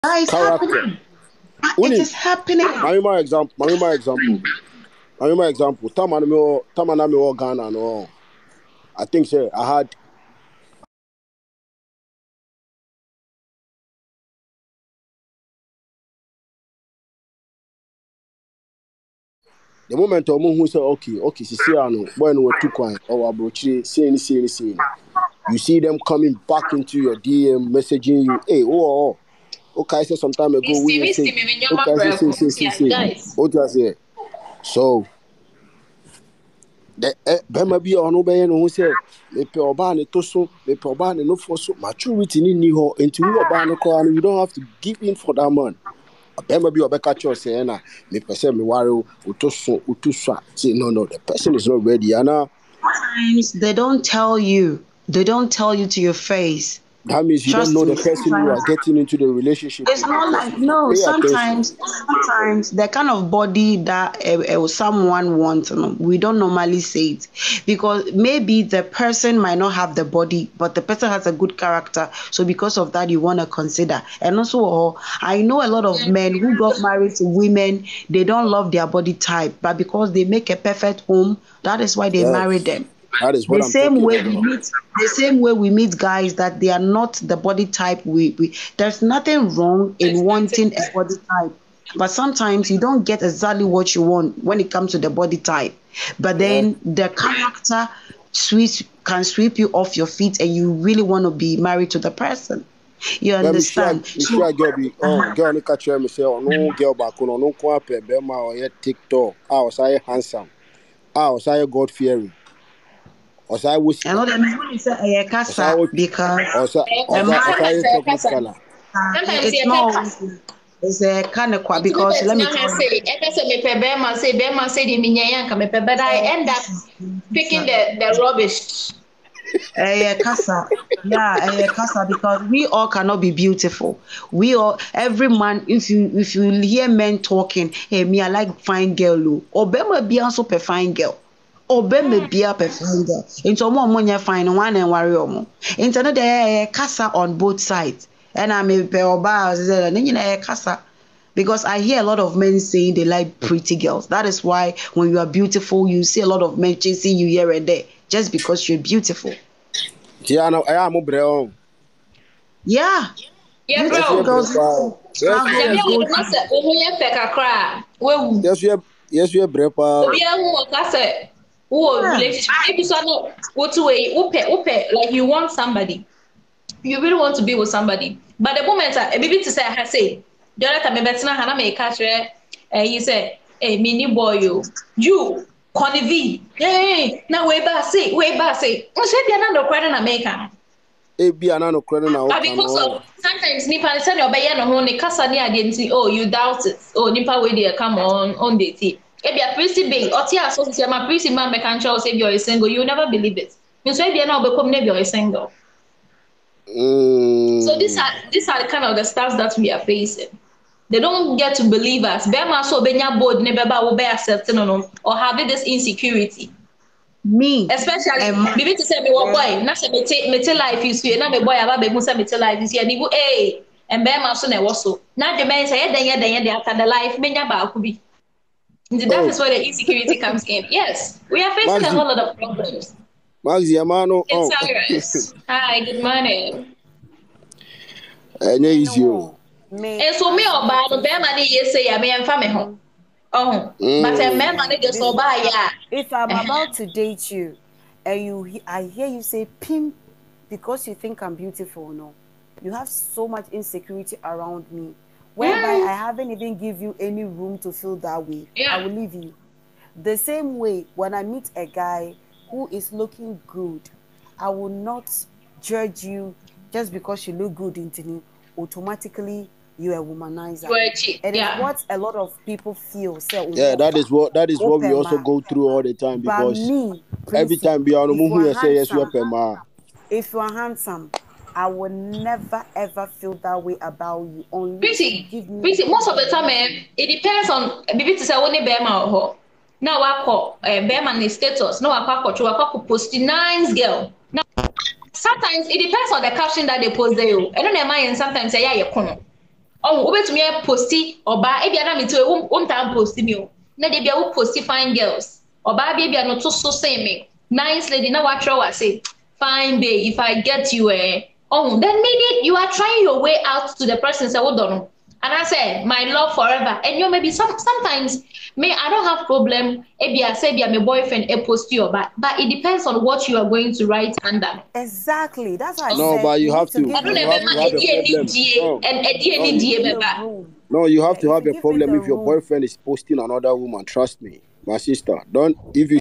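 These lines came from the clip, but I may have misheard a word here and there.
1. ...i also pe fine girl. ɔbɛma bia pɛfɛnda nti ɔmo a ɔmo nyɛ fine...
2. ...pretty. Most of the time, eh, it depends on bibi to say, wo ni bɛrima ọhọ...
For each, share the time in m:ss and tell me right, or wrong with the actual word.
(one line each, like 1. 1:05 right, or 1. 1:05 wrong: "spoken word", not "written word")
1. 2:20 right
2. 4:45 wrong: "bẹẹma", not "bɛrima".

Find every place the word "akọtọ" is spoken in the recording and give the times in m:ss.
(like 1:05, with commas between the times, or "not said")
4:52.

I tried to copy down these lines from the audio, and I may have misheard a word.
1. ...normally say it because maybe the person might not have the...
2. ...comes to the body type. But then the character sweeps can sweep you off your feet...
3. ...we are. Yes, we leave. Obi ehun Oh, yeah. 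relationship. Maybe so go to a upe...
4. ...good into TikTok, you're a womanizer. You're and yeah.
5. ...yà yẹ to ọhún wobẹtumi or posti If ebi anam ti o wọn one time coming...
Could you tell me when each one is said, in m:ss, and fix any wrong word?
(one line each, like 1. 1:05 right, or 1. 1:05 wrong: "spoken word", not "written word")
1. 1:06 right
2. 1:34 right
3. 2:48 wrong: "brave", not "leave"
4. 4:27 wrong: "Automatically", not "TikTok"
5. 4:58 wrong: "posting", not "coming".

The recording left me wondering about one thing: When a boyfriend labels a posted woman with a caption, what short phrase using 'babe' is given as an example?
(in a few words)
fine babe.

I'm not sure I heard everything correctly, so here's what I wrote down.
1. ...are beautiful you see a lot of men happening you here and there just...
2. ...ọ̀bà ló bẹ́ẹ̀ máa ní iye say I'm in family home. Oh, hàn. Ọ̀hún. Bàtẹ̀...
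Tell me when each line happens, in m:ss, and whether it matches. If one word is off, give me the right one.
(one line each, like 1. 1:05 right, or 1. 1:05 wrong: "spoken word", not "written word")
1. 2:35 wrong: "chasing", not "happening"
2. 4:00 right.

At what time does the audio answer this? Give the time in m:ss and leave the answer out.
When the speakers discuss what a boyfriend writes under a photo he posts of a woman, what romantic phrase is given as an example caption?
5:15.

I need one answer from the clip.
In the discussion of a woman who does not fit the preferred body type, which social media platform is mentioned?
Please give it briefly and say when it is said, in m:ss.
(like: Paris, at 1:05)
TikTok, at 1:48.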